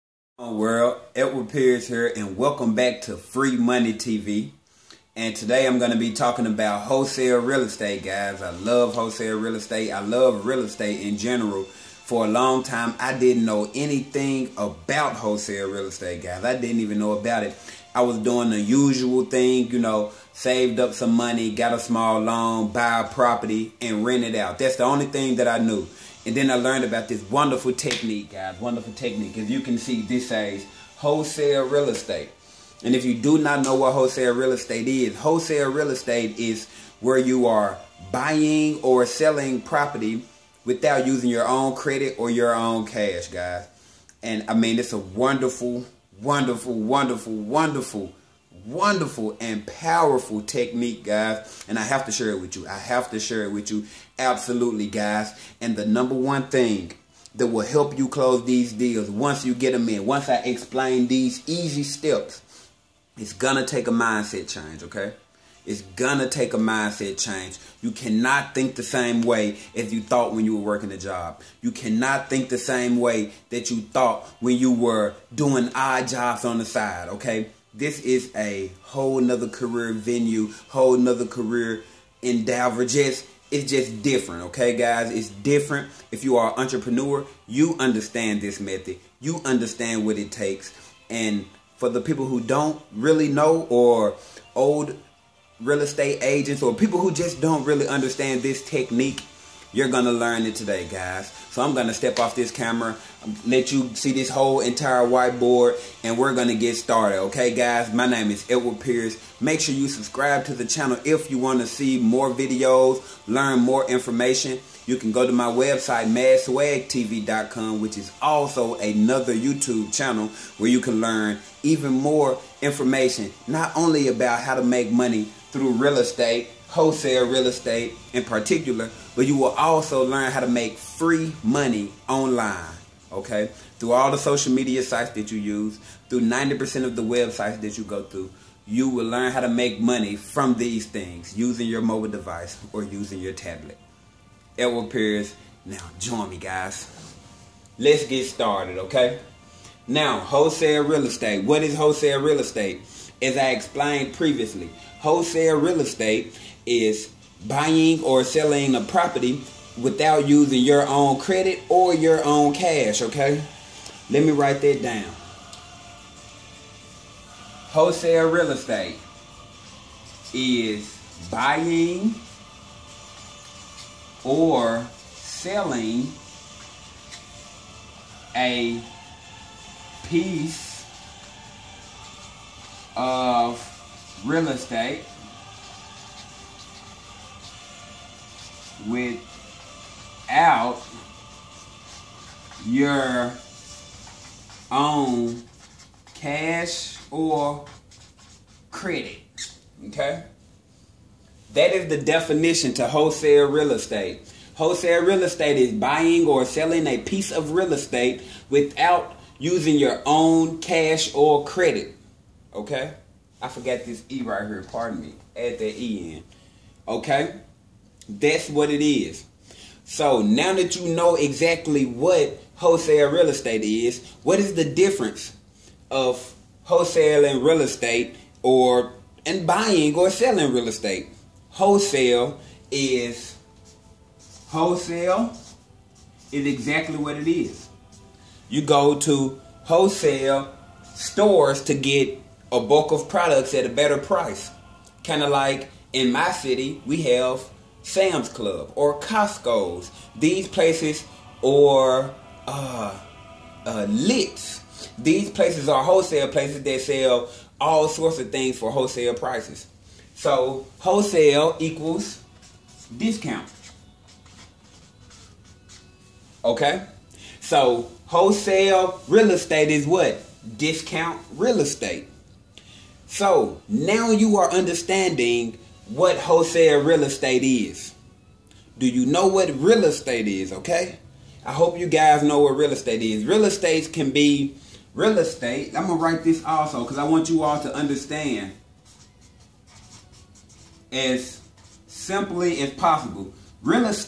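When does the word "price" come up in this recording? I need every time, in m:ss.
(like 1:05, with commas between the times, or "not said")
4:03, 4:19.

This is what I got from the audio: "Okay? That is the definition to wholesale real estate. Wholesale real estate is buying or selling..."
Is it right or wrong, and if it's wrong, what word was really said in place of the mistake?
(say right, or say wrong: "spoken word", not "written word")
right.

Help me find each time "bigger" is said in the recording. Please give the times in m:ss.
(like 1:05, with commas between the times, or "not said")
not said.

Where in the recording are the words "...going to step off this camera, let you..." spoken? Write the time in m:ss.
1:41.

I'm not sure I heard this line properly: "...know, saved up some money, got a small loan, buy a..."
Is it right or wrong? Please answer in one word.
right.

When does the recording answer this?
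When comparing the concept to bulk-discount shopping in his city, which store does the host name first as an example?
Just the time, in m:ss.
4:07.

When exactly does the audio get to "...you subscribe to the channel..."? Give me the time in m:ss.
1:49.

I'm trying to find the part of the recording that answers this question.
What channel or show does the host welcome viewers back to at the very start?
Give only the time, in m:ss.
0:03.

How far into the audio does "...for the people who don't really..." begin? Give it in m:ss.
1:31.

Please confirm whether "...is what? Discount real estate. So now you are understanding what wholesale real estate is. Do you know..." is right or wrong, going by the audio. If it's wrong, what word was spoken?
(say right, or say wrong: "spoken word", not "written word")
right.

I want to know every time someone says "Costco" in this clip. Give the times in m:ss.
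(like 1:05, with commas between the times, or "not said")
4:08.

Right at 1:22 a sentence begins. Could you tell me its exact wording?
Just it's just different, okay, guys?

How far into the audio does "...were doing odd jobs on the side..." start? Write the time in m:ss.
1:14.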